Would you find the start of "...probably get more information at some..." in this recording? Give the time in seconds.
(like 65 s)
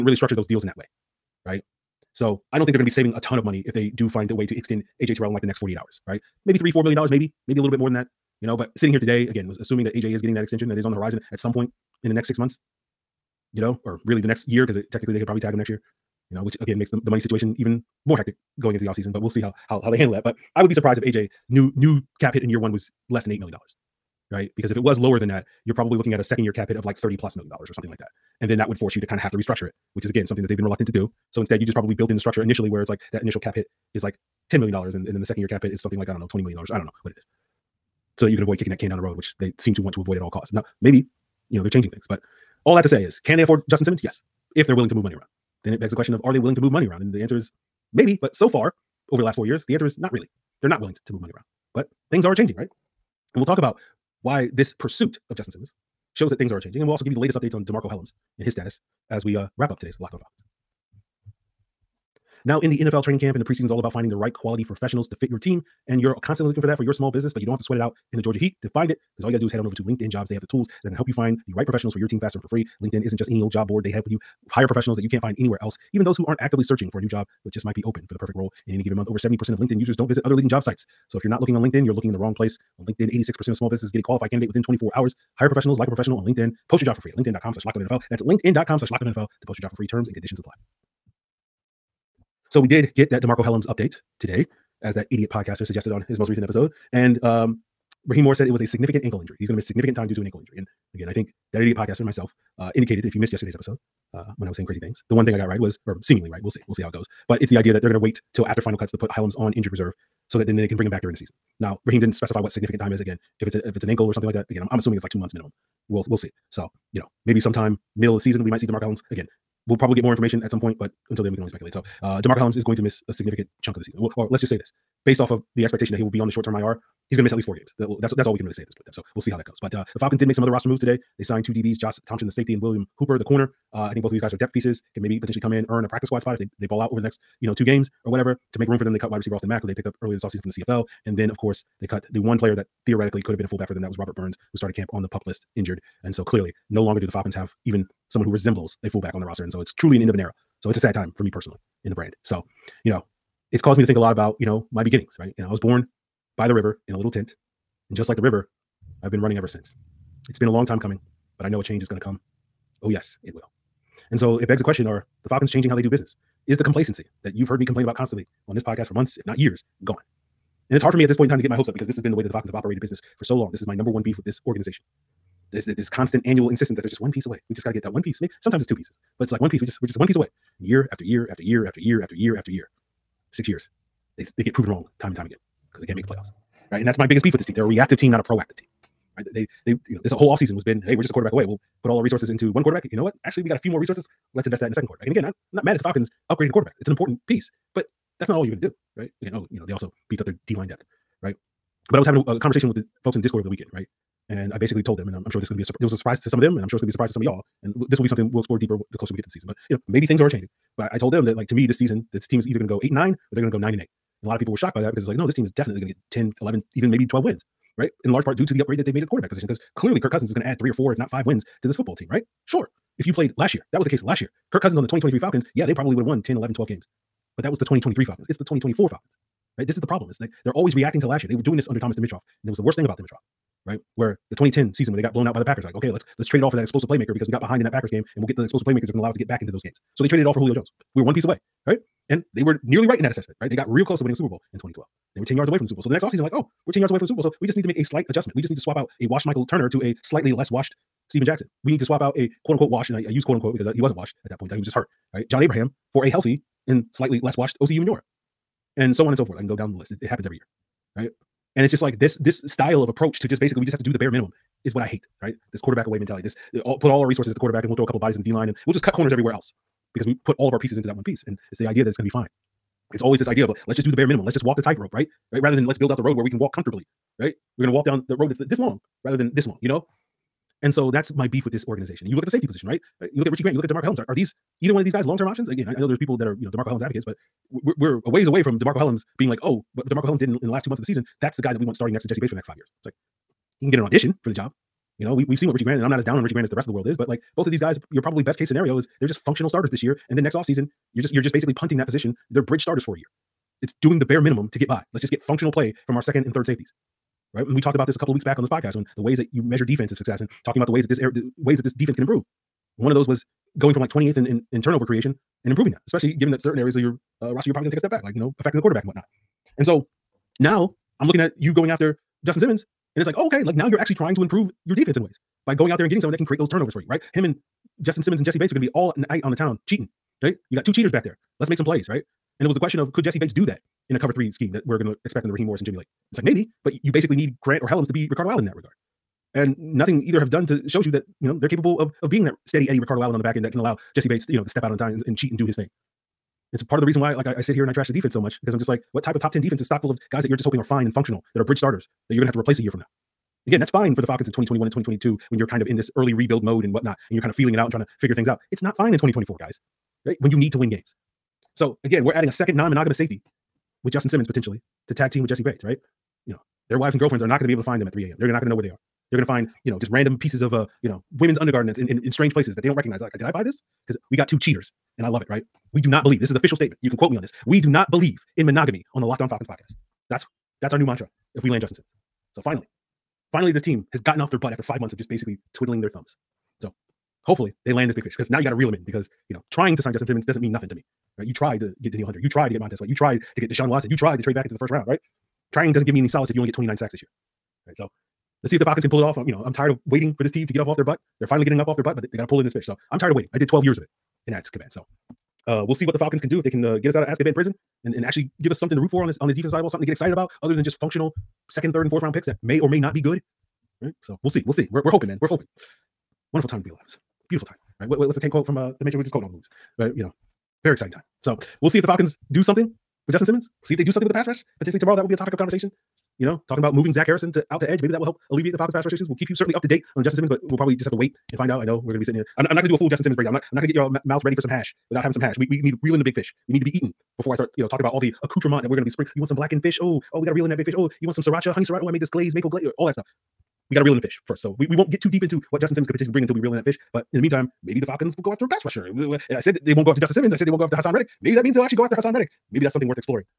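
119 s.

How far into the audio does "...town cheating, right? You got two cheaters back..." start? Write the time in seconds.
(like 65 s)
329 s.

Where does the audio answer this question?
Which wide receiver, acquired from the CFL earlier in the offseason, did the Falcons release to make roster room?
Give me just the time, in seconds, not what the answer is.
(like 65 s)
139 s.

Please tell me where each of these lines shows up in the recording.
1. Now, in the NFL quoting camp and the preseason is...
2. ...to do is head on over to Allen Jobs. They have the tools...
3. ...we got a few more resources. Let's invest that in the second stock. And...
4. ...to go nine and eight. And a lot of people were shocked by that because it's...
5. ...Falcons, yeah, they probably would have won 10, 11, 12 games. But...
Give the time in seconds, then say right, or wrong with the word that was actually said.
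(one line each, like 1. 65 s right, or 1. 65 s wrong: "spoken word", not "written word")
1. 62 s wrong: "training", not "quoting"
2. 69 s wrong: "LinkedIn", not "Allen"
3. 193 s wrong: "quarterback", not "stock"
4. 213 s right
5. 225 s right.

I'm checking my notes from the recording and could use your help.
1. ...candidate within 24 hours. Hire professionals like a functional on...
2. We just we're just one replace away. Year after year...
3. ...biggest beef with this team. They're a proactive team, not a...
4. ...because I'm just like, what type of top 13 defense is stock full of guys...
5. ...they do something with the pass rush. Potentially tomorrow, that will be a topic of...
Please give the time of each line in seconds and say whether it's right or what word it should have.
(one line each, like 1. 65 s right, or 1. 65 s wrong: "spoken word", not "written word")
1. 84 s wrong: "professional", not "functional"
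2. 179 s wrong: "piece", not "replace"
3. 187 s wrong: "reactive", not "proactive"
4. 348 s wrong: "10", not "13"
5. 423 s right.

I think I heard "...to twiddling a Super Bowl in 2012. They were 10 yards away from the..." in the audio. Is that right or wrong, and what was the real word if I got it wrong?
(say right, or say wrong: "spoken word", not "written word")
wrong: "winning", not "twiddling".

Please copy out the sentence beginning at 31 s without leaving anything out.
So instead, you just probably built in the structure initially where it's like that initial cap hit is like $10 million.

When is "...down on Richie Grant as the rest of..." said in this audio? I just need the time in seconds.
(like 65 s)
296 s.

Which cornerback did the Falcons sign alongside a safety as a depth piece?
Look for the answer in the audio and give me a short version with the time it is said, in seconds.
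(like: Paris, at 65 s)
William Hooper, at 132 s.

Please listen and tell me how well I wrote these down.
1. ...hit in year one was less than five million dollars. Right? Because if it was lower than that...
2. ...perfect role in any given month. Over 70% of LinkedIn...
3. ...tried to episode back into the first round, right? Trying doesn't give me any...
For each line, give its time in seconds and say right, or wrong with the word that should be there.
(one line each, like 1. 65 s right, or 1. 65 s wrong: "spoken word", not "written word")
1. 22 s wrong: "eight", not "five"
2. 78 s right
3. 393 s wrong: "trade", not "episode".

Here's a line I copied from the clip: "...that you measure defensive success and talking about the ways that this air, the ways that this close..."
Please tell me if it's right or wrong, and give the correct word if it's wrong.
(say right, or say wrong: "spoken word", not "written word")
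wrong: "defense", not "close".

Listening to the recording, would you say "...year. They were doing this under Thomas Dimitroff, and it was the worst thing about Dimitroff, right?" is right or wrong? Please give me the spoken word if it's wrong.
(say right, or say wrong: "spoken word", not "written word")
right.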